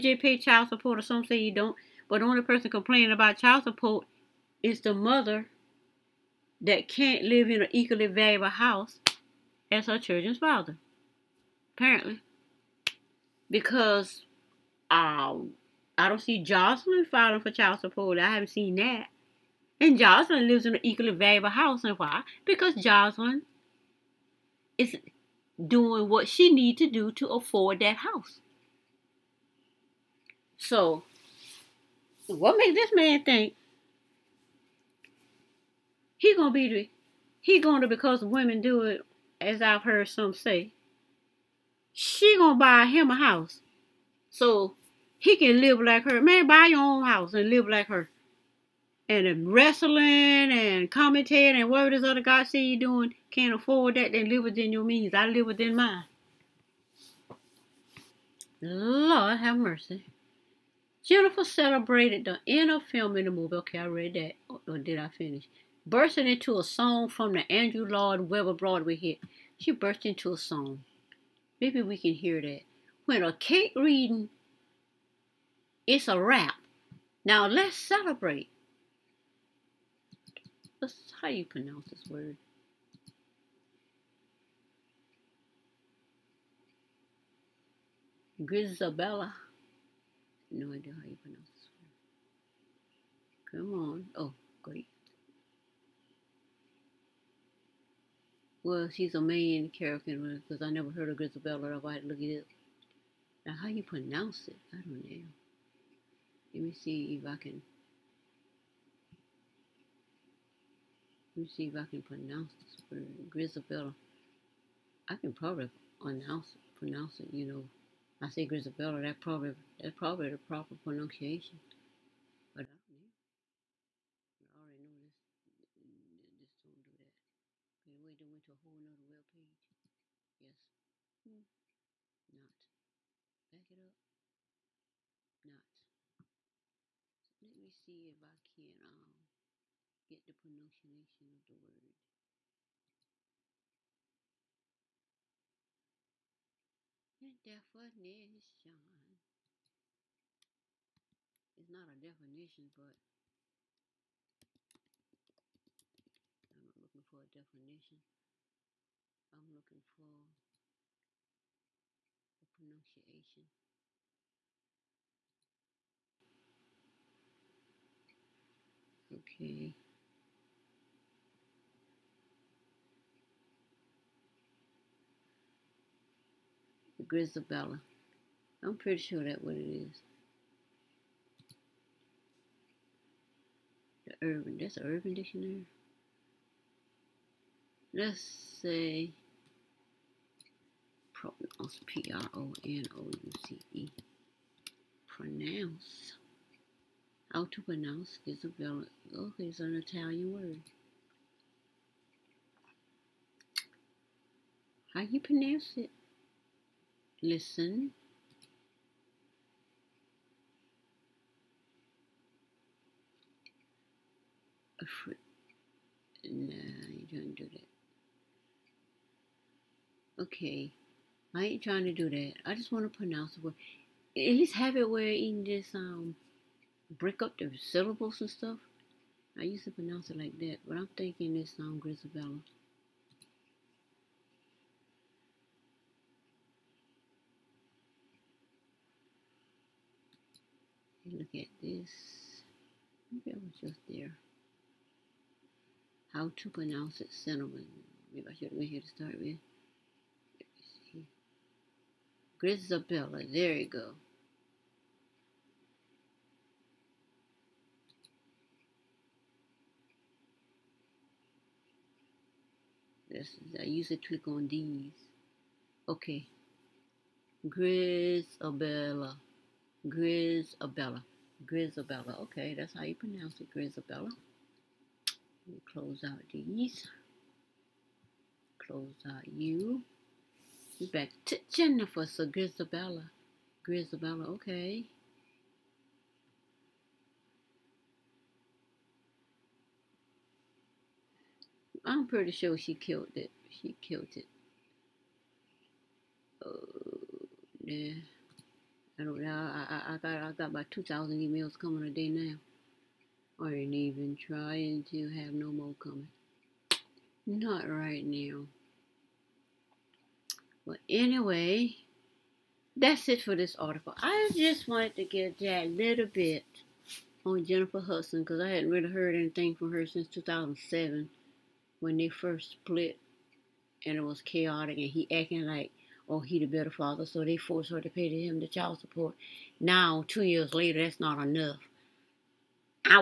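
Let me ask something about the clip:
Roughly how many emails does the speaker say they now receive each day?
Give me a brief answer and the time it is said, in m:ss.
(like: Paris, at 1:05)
2,000, at 5:00.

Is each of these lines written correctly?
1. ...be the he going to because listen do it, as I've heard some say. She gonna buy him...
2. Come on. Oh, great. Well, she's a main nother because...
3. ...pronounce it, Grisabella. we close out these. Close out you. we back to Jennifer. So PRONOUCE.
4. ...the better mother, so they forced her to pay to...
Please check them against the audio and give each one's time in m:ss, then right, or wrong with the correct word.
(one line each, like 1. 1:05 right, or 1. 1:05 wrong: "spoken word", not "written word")
1. 0:36 wrong: "women", not "listen"
2. 1:33 wrong: "character", not "nother"
3. 4:32 wrong: "Grisabella", not "PRONOUCE"
4. 5:26 wrong: "father", not "mother".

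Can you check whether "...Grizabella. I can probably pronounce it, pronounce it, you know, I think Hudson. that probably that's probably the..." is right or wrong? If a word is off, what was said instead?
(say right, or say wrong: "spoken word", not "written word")
wrong: "Isabella", not "Hudson".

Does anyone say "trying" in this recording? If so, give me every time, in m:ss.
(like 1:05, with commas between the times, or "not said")
3:41, 5:04.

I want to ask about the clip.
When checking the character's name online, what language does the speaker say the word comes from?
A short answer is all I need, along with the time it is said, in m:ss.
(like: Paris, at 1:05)
Italian, at 3:19.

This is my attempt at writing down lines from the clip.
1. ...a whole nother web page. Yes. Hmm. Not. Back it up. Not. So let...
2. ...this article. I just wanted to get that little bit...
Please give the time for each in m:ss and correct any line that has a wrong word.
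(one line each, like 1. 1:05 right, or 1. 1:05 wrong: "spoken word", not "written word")
1. 2:08 right
2. 5:13 right.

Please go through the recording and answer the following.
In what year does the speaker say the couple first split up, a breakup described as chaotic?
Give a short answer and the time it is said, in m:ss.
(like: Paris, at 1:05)
2007, at 5:20.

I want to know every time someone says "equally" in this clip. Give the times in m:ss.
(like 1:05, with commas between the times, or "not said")
0:07, 0:20.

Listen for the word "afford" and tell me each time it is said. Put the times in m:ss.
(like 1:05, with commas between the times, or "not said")
0:27, 0:53.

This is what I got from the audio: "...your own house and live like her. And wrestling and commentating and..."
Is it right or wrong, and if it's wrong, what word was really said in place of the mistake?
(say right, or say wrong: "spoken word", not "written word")
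right.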